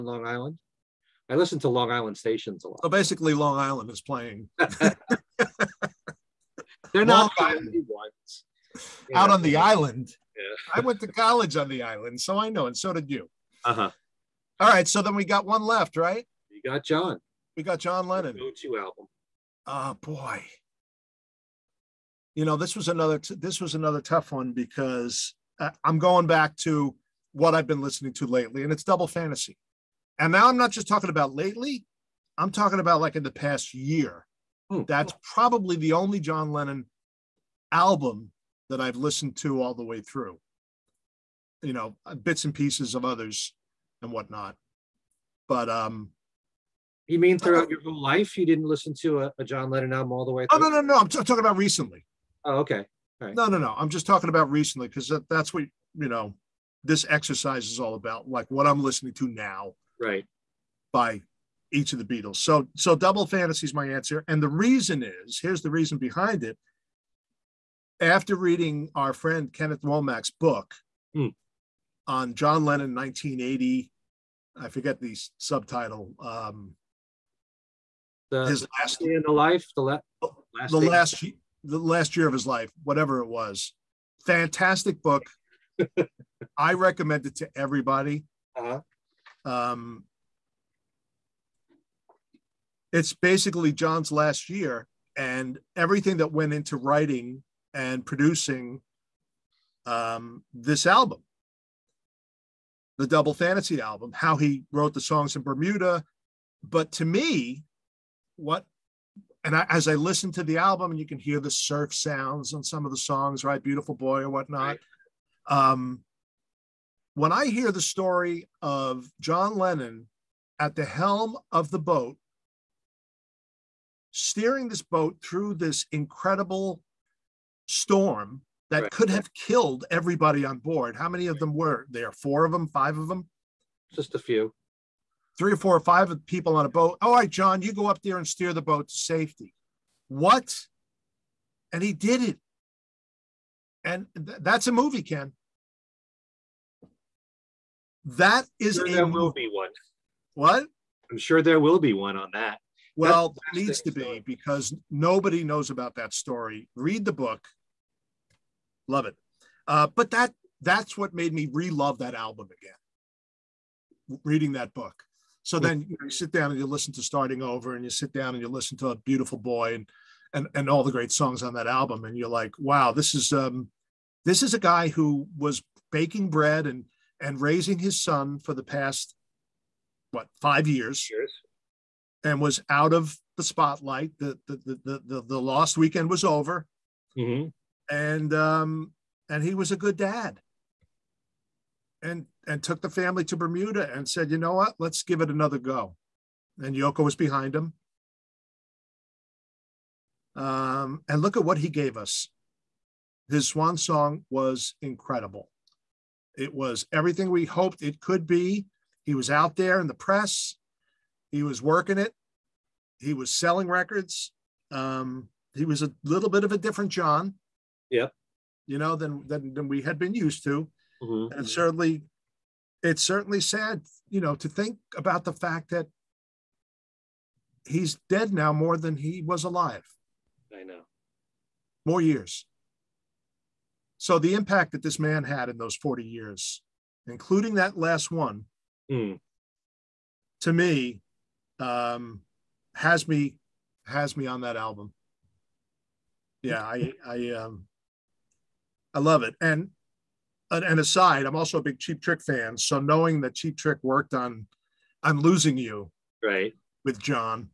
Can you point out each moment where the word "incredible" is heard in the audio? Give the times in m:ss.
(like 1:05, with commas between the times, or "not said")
2:05, 3:24.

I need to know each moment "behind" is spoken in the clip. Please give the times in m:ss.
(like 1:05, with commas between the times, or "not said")
1:05, 3:17.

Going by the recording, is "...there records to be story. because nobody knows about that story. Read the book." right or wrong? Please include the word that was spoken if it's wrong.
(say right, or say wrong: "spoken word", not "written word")
wrong: "needs", not "records".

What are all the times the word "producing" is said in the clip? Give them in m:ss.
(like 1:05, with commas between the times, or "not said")
1:38.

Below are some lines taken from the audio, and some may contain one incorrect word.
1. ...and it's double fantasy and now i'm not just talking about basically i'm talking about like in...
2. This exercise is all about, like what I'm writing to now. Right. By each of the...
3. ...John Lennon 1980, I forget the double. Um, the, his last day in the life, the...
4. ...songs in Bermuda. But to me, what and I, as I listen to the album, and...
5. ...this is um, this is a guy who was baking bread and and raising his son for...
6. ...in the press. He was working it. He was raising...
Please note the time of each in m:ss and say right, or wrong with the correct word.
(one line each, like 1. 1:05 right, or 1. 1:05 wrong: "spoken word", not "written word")
1. 0:28 wrong: "lately", not "basically"
2. 0:56 wrong: "listening", not "writing"
3. 1:12 wrong: "subtitle", not "double"
4. 1:45 right
5. 2:52 right
6. 3:29 wrong: "selling", not "raising".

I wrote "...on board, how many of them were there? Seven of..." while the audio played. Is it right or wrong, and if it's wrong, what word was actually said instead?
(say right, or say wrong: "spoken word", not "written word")
wrong: "Four", not "Seven".